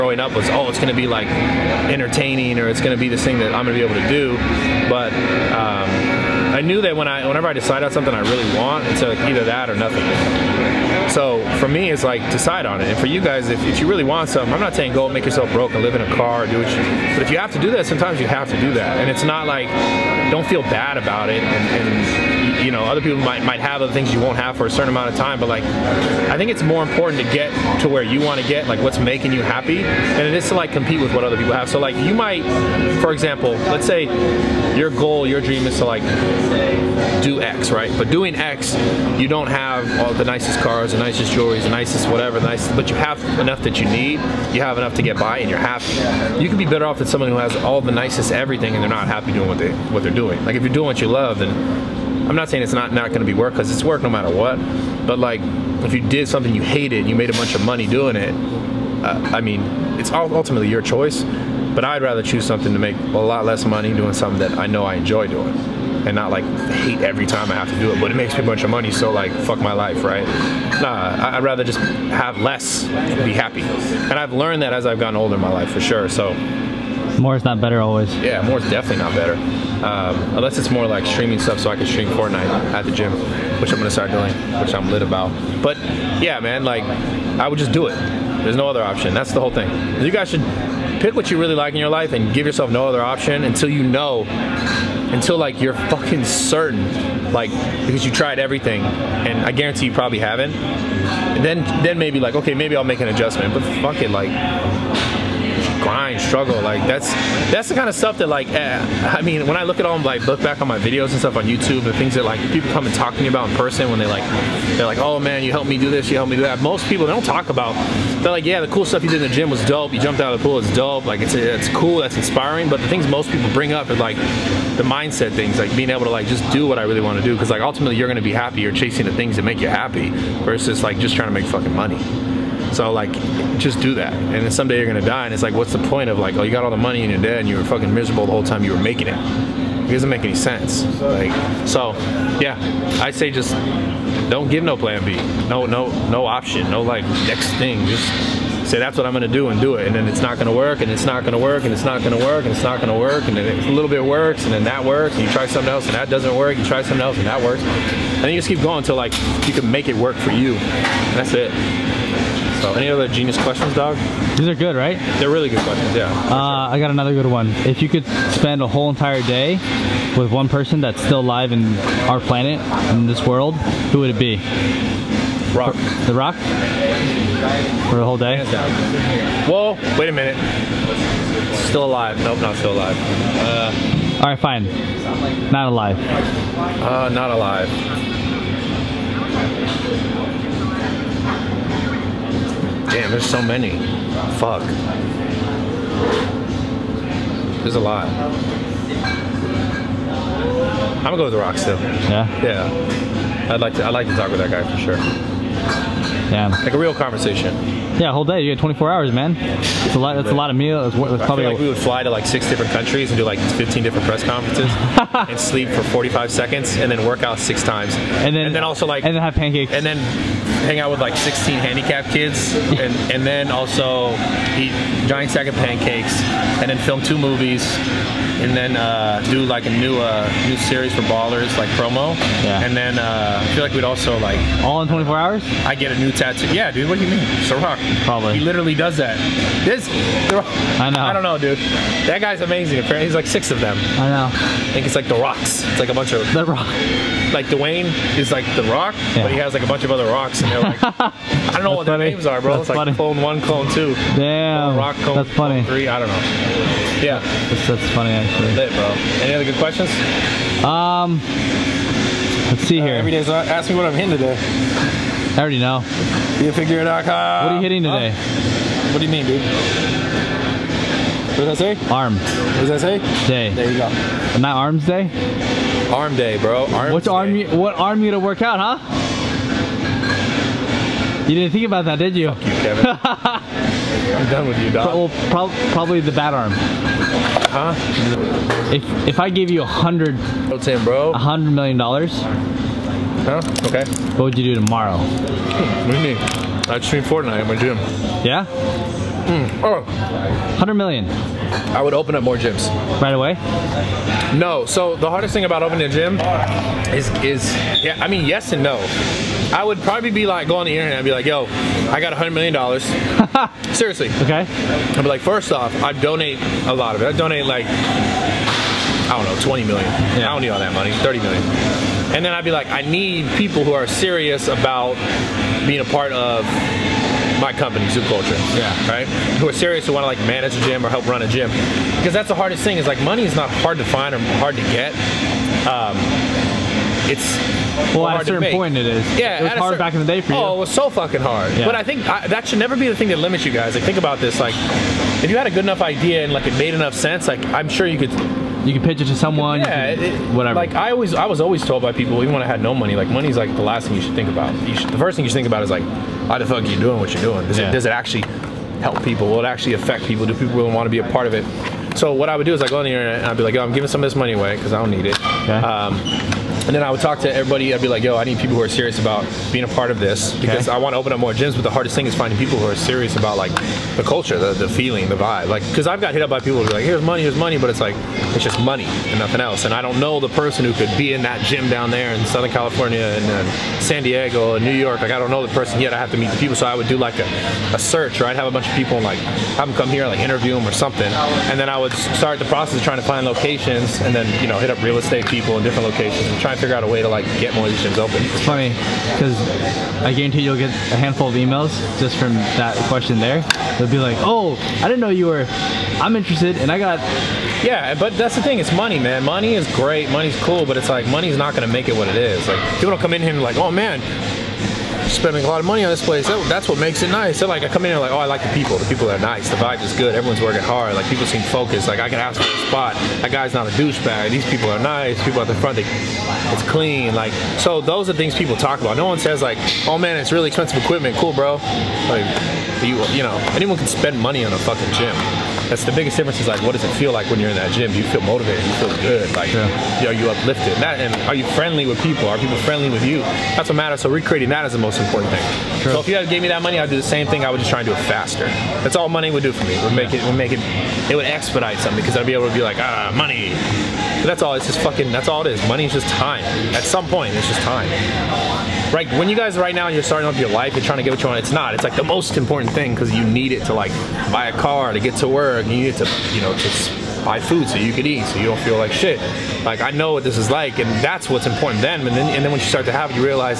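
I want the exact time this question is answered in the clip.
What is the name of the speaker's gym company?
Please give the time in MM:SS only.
05:27.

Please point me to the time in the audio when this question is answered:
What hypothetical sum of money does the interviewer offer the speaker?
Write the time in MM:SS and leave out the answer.
04:51.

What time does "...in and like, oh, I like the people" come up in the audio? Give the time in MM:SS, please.
06:57.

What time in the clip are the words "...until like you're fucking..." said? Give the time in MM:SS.
01:35.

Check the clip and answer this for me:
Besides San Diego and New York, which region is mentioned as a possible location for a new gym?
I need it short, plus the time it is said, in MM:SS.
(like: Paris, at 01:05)
Southern California, at 06:22.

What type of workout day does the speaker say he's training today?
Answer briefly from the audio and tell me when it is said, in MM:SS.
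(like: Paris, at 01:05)
Arm day, at 04:35.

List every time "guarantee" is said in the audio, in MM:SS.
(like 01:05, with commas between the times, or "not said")
01:39, 06:40.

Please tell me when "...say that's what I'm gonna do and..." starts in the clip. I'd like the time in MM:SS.
02:28.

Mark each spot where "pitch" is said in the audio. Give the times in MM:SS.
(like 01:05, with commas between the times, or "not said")
05:48.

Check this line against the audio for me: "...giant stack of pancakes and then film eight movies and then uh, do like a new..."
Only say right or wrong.
wrong.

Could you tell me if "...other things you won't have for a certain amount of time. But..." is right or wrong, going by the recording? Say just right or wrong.
right.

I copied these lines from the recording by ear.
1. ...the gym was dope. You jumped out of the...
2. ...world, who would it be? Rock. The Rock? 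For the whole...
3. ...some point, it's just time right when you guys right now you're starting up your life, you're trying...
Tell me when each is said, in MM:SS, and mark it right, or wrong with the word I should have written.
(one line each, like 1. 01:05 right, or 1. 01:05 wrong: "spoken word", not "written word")
1. 01:59 right
2. 02:53 right
3. 07:36 right.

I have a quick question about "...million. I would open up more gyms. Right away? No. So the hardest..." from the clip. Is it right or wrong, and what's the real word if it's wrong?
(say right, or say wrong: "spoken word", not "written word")
right.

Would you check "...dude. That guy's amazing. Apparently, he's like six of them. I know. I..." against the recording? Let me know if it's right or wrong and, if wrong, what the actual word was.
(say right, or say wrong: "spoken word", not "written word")
right.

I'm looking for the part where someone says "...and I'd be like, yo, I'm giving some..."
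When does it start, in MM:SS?
06:03.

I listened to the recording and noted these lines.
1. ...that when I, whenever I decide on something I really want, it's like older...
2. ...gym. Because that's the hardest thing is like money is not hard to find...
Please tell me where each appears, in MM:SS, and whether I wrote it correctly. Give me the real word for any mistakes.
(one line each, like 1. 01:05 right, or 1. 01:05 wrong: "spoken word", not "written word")
1. 00:06 wrong: "either", not "older"
2. 05:31 right.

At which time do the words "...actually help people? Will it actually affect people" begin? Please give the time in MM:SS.
05:57.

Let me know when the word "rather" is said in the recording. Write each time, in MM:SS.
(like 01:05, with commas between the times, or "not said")
01:02, 01:11.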